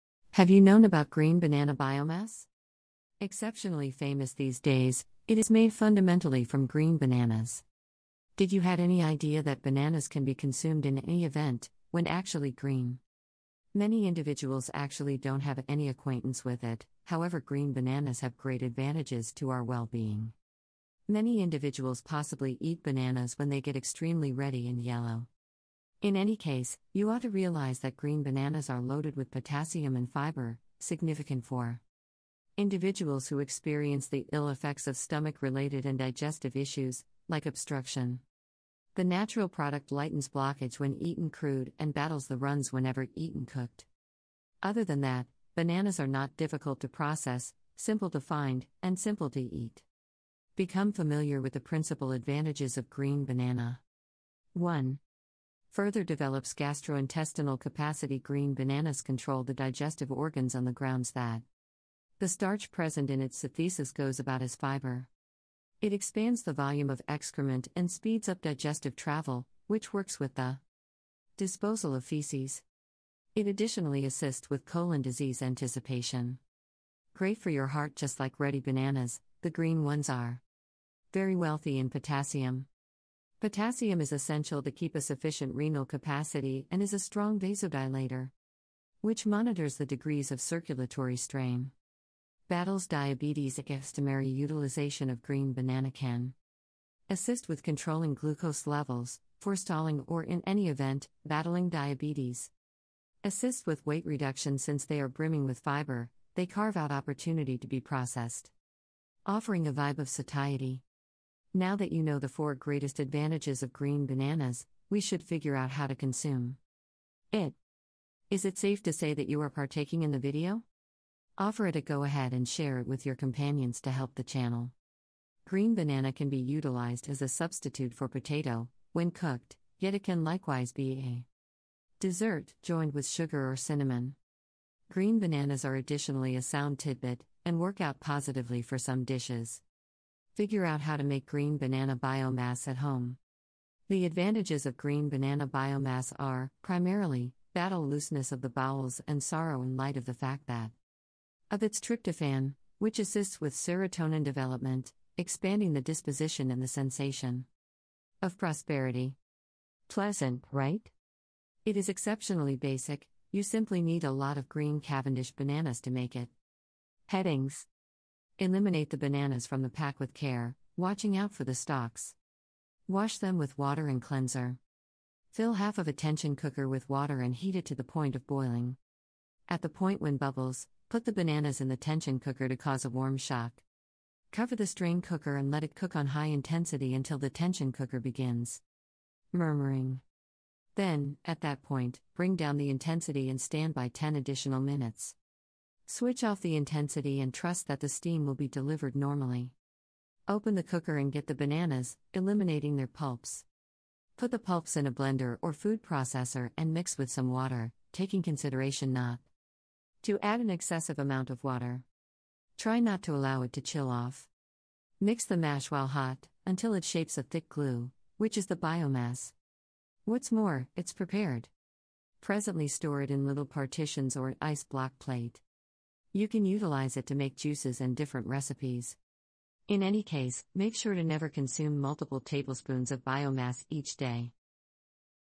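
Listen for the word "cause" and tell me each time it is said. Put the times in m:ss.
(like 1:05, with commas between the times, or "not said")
3:02.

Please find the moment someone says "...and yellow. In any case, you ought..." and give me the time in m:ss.
0:24.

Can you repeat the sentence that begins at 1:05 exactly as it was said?
It expands the volume of excrement and speeds up digestive travel, which works with the disposal of feces.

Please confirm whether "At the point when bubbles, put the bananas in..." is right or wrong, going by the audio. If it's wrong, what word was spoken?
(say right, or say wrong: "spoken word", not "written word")
right.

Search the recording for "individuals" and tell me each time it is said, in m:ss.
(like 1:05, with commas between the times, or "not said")
0:14, 0:21, 0:32.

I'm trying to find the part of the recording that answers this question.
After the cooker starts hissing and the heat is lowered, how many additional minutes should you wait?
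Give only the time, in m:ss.
3:13.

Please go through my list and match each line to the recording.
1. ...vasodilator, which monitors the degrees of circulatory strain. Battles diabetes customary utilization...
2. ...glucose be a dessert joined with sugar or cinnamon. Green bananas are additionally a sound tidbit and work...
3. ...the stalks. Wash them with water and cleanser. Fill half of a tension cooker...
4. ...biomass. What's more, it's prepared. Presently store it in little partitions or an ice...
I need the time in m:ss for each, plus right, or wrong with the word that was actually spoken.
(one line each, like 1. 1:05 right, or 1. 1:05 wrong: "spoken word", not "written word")
1. 1:27 right
2. 2:10 wrong: "likewise", not "glucose"
3. 2:51 right
4. 3:38 right.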